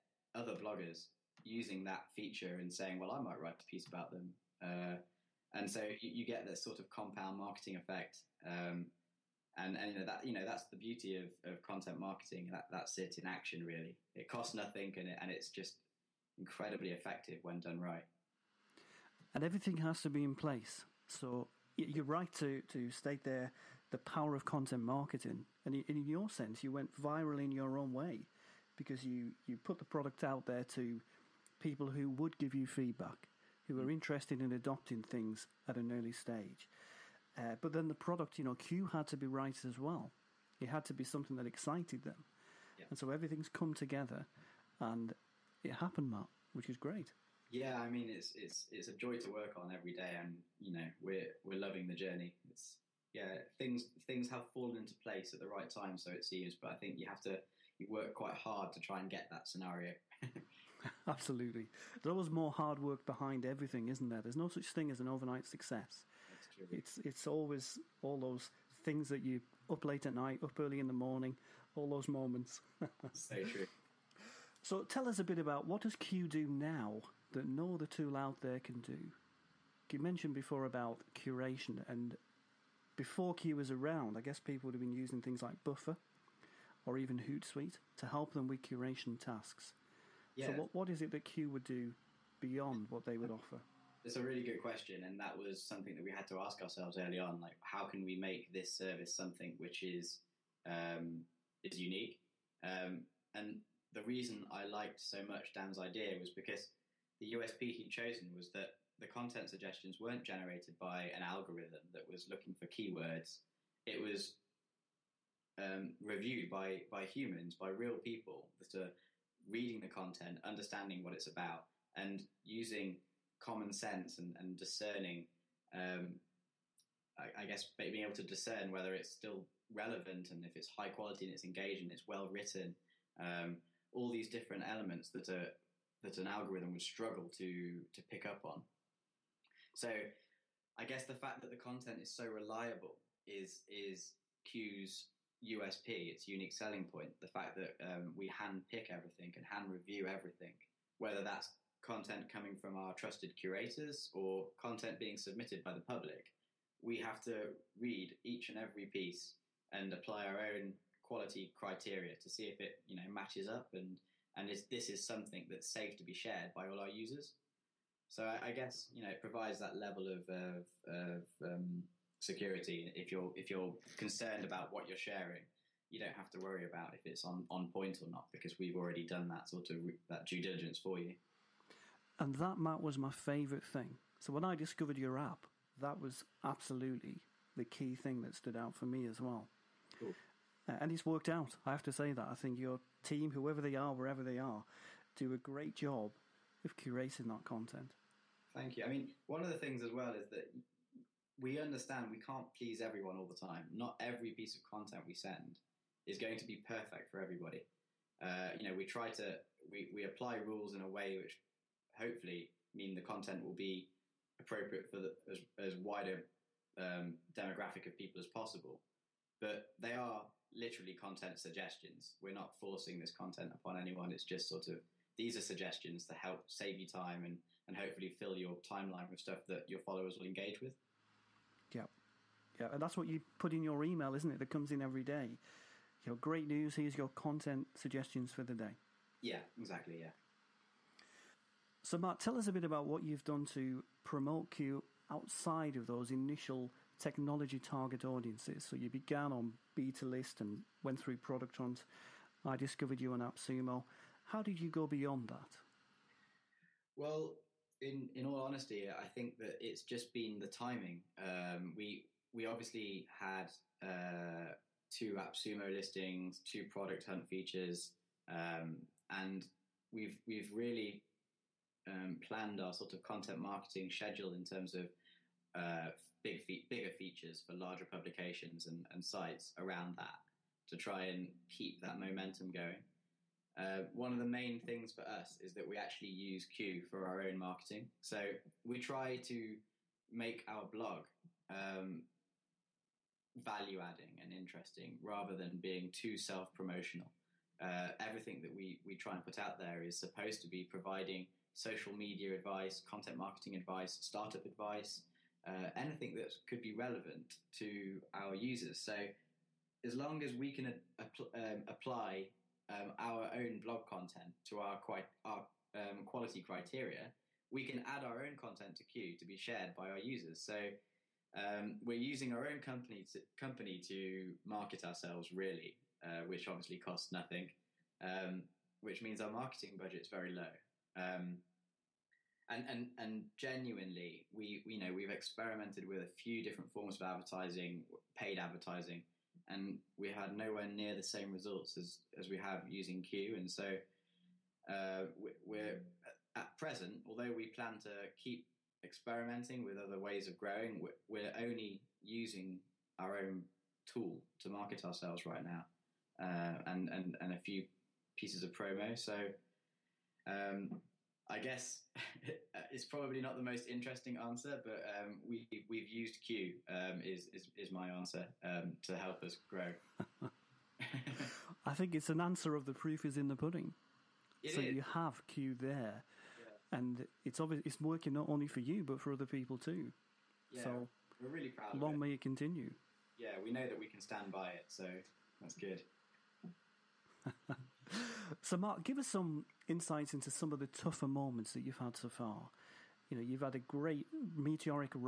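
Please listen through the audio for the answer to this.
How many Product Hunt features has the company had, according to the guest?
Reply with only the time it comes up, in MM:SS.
04:26.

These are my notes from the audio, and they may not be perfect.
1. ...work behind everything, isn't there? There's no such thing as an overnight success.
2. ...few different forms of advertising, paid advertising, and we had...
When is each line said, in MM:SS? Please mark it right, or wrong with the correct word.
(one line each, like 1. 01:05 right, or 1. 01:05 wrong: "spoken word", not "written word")
1. 01:02 right
2. 05:36 right.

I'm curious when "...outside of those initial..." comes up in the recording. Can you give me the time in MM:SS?
04:05.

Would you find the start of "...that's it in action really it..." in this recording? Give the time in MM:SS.
00:12.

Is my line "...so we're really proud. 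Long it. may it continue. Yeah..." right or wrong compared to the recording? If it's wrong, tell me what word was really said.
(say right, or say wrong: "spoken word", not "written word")
right.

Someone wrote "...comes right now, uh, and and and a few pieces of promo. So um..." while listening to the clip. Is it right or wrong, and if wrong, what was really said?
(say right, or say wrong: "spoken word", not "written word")
wrong: "ourselves", not "comes".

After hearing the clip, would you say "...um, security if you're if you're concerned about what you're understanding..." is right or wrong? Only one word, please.
wrong.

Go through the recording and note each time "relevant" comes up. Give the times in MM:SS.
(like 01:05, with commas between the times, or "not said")
02:09, 05:06.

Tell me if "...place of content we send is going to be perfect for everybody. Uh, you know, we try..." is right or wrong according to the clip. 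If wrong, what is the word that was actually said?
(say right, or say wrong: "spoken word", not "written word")
wrong: "piece", not "place".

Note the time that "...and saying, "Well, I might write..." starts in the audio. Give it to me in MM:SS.
00:02.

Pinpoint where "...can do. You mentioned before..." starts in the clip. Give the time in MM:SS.
01:18.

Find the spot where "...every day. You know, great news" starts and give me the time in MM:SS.
03:54.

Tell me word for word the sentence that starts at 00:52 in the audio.
It's yeah, things things have fallen into place at the right time, so it seems.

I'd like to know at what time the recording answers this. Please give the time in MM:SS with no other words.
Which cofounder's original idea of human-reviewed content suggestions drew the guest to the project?
01:45.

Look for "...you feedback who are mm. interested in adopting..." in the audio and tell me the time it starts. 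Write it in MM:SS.
00:32.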